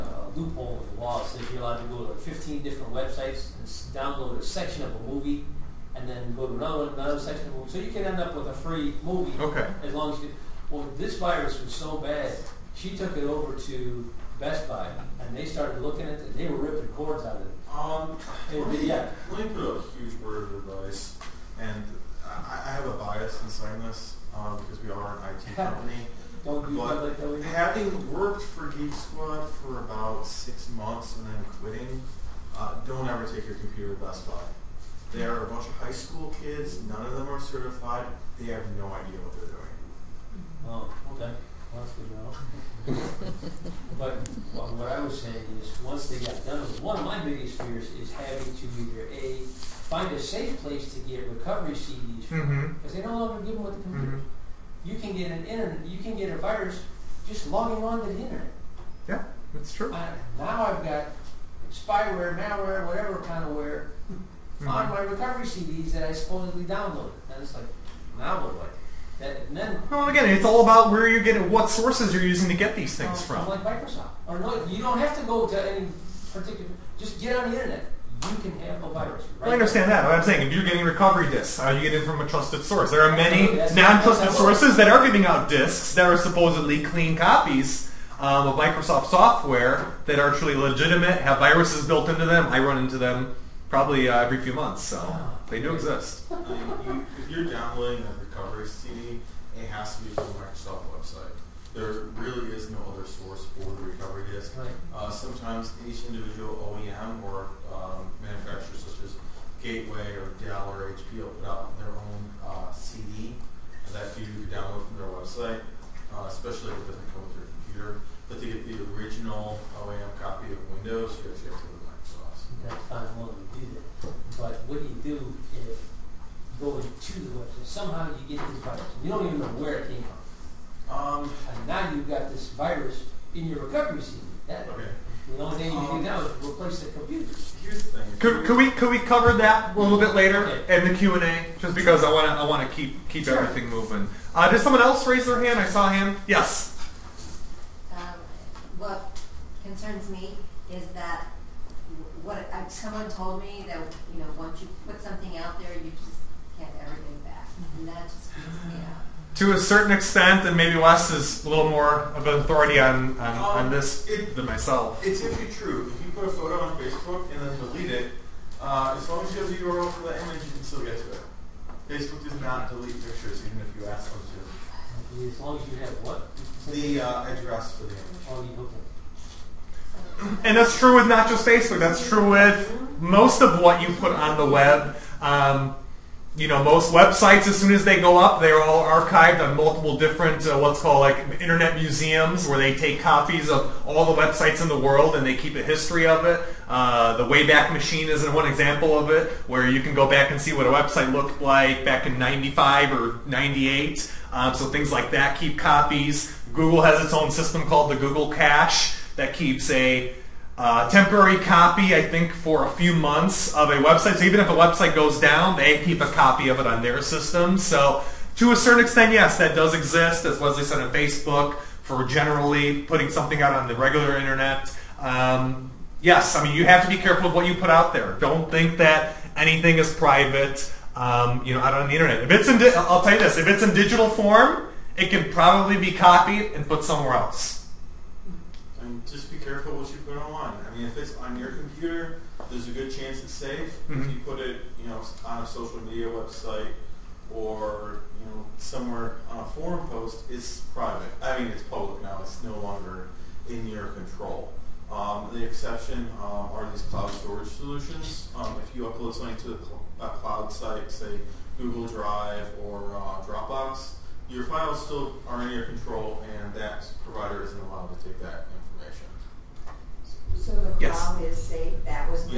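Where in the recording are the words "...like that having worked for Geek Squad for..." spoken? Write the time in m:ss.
0:27.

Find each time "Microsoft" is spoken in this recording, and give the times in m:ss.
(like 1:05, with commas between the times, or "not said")
1:13, 1:28, 1:40.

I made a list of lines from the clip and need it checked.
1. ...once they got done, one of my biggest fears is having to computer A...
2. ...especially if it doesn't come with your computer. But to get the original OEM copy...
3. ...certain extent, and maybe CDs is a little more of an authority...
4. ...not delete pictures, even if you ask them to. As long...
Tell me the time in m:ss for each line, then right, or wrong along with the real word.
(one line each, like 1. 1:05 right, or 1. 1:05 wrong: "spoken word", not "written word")
1. 0:45 wrong: "either", not "computer"
2. 1:56 right
3. 2:39 wrong: "Wes", not "CDs"
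4. 2:52 right.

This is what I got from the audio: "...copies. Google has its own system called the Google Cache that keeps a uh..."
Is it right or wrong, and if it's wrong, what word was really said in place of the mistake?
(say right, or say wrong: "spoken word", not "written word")
right.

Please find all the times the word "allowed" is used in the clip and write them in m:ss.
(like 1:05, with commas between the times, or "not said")
0:01, 4:27.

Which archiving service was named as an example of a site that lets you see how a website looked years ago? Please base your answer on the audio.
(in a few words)
the Wayback Machine.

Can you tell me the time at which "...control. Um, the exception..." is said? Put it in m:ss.
4:13.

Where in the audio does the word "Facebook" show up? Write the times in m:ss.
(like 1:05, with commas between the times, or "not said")
2:46, 2:51, 3:01, 3:40.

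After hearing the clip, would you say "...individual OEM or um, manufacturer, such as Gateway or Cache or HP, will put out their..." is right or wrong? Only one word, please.
wrong.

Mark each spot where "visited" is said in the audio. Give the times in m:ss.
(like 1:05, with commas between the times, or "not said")
not said.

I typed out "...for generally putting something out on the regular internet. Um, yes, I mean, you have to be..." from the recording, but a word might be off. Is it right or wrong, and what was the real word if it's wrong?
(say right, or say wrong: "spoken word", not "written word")
right.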